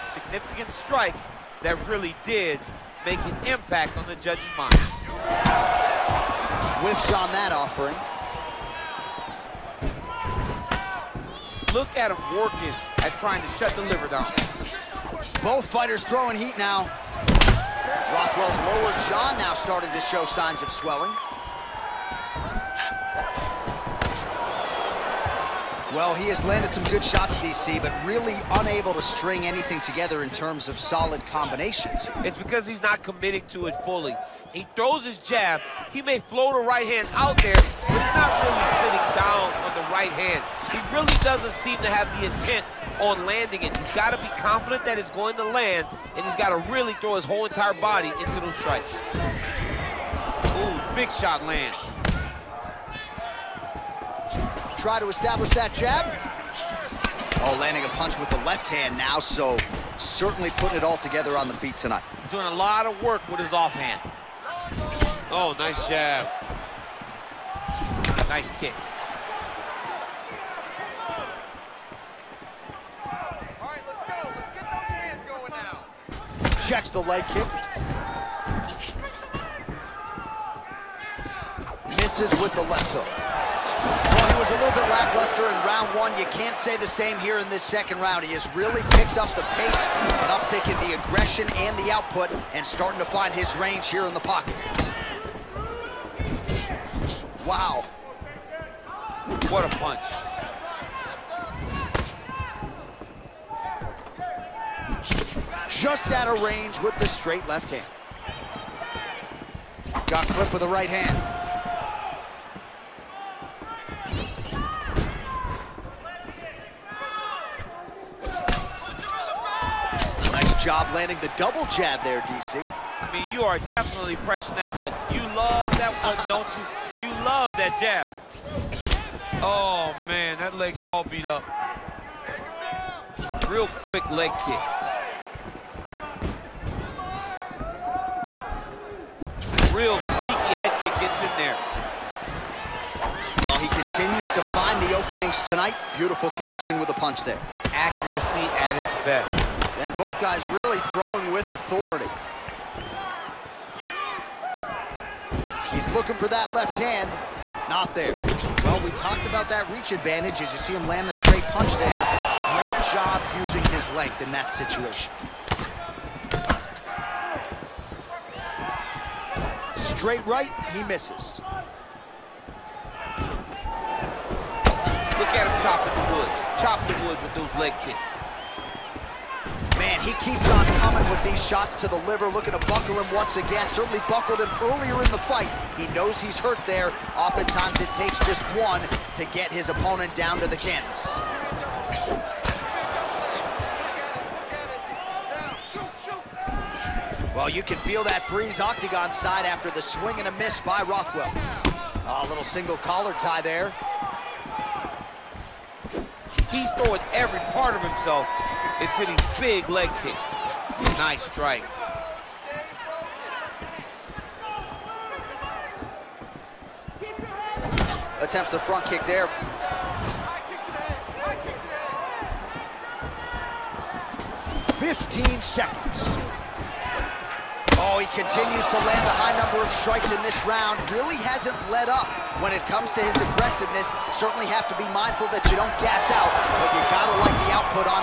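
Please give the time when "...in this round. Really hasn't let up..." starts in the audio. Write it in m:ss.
3:50.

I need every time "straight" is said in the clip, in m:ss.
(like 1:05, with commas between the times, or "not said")
1:47, 2:41, 2:49.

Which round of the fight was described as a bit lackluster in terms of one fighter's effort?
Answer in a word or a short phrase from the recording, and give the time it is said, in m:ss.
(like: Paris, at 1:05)
Round one, at 1:25.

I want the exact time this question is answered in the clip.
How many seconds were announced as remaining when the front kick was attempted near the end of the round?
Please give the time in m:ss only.
3:44.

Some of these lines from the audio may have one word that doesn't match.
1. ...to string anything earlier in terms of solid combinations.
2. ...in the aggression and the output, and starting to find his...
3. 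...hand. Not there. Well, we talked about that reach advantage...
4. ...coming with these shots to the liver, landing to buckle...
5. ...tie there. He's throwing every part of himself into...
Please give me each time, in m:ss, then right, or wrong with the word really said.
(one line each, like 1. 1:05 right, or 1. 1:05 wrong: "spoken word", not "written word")
1. 0:28 wrong: "together", not "earlier"
2. 1:30 right
3. 2:36 right
4. 3:00 wrong: "looking", not "landing"
5. 3:23 right.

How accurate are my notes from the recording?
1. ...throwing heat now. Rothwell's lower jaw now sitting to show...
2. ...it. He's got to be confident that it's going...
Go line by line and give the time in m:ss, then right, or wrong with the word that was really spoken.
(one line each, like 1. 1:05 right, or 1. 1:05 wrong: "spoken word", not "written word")
1. 0:16 wrong: "starting", not "sitting"
2. 0:43 right.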